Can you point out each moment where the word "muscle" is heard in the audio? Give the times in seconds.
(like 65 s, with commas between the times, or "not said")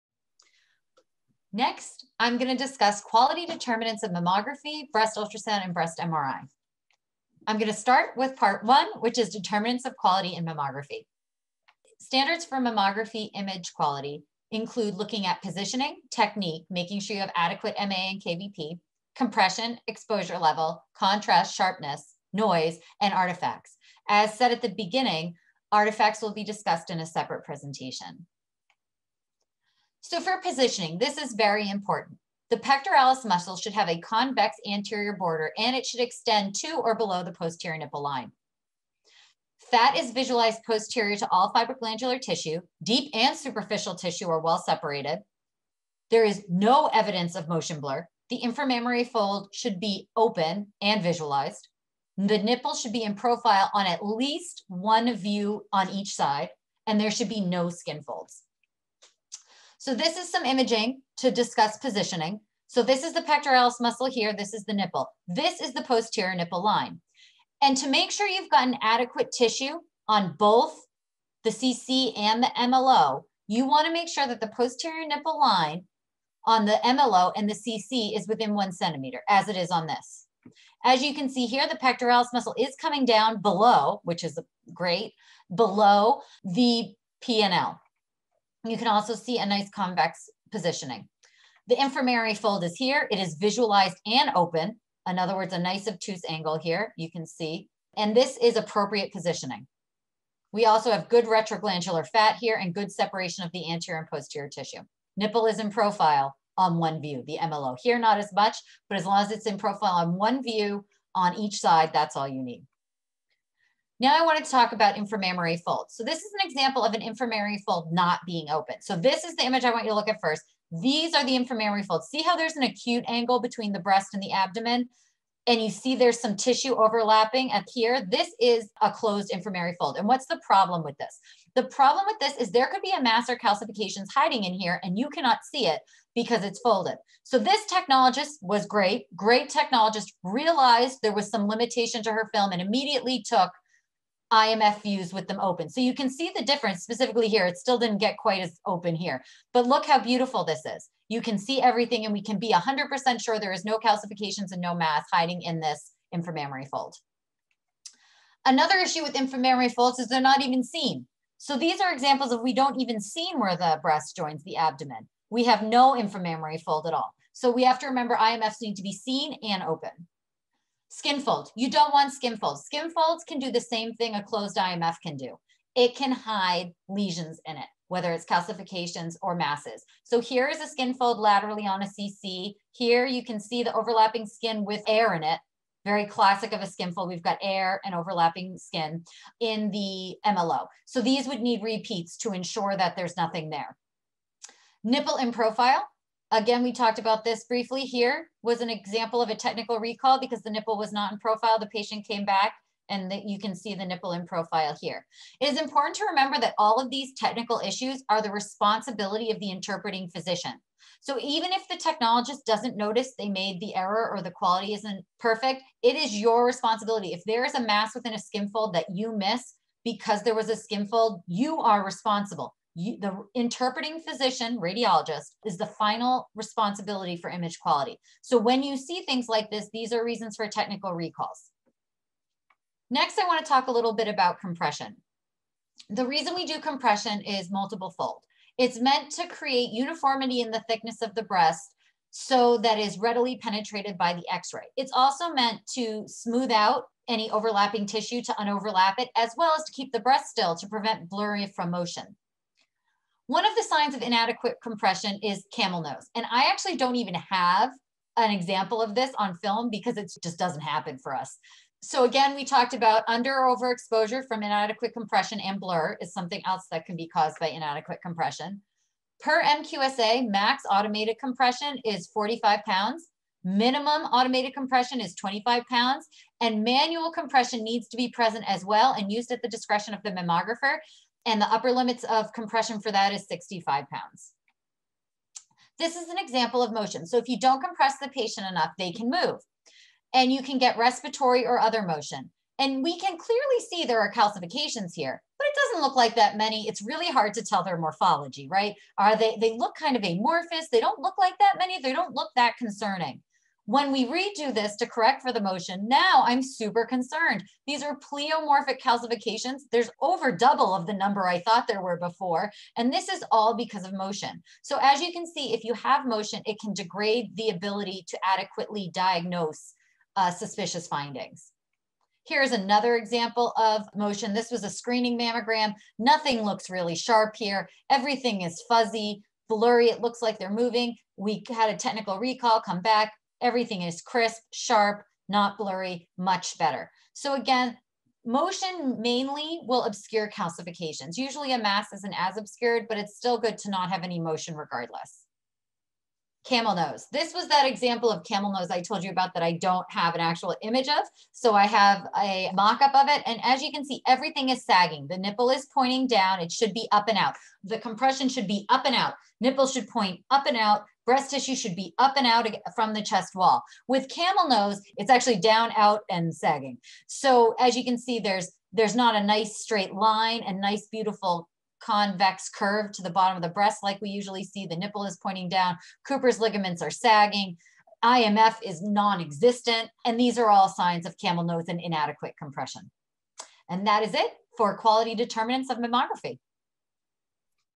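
33 s, 63 s, 82 s.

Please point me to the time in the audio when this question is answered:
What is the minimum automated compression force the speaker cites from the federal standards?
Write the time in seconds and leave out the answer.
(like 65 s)
275 s.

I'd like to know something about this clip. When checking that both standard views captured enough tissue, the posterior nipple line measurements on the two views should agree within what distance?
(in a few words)
1 centimeter.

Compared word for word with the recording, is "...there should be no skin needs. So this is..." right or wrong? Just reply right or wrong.
wrong.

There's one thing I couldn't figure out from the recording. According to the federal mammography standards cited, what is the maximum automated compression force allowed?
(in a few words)
45 pounds.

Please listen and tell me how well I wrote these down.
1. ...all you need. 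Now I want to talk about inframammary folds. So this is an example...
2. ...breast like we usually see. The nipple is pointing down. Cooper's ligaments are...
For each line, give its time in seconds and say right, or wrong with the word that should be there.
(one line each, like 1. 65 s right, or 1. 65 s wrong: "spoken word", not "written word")
1. 112 s right
2. 373 s right.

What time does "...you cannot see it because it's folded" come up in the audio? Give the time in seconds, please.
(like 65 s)
134 s.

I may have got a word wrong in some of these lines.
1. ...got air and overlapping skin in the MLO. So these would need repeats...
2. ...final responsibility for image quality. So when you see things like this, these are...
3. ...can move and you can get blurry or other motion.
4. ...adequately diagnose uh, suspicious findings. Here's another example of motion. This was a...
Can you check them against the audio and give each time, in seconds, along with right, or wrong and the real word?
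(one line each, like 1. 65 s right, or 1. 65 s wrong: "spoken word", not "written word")
1. 187 s right
2. 225 s right
3. 288 s wrong: "respiratory", not "blurry"
4. 318 s right.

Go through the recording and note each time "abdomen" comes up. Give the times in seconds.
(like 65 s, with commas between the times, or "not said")
124 s, 164 s.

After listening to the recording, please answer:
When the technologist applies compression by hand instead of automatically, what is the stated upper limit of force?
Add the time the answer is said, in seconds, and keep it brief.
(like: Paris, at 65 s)
65 pounds, at 283 s.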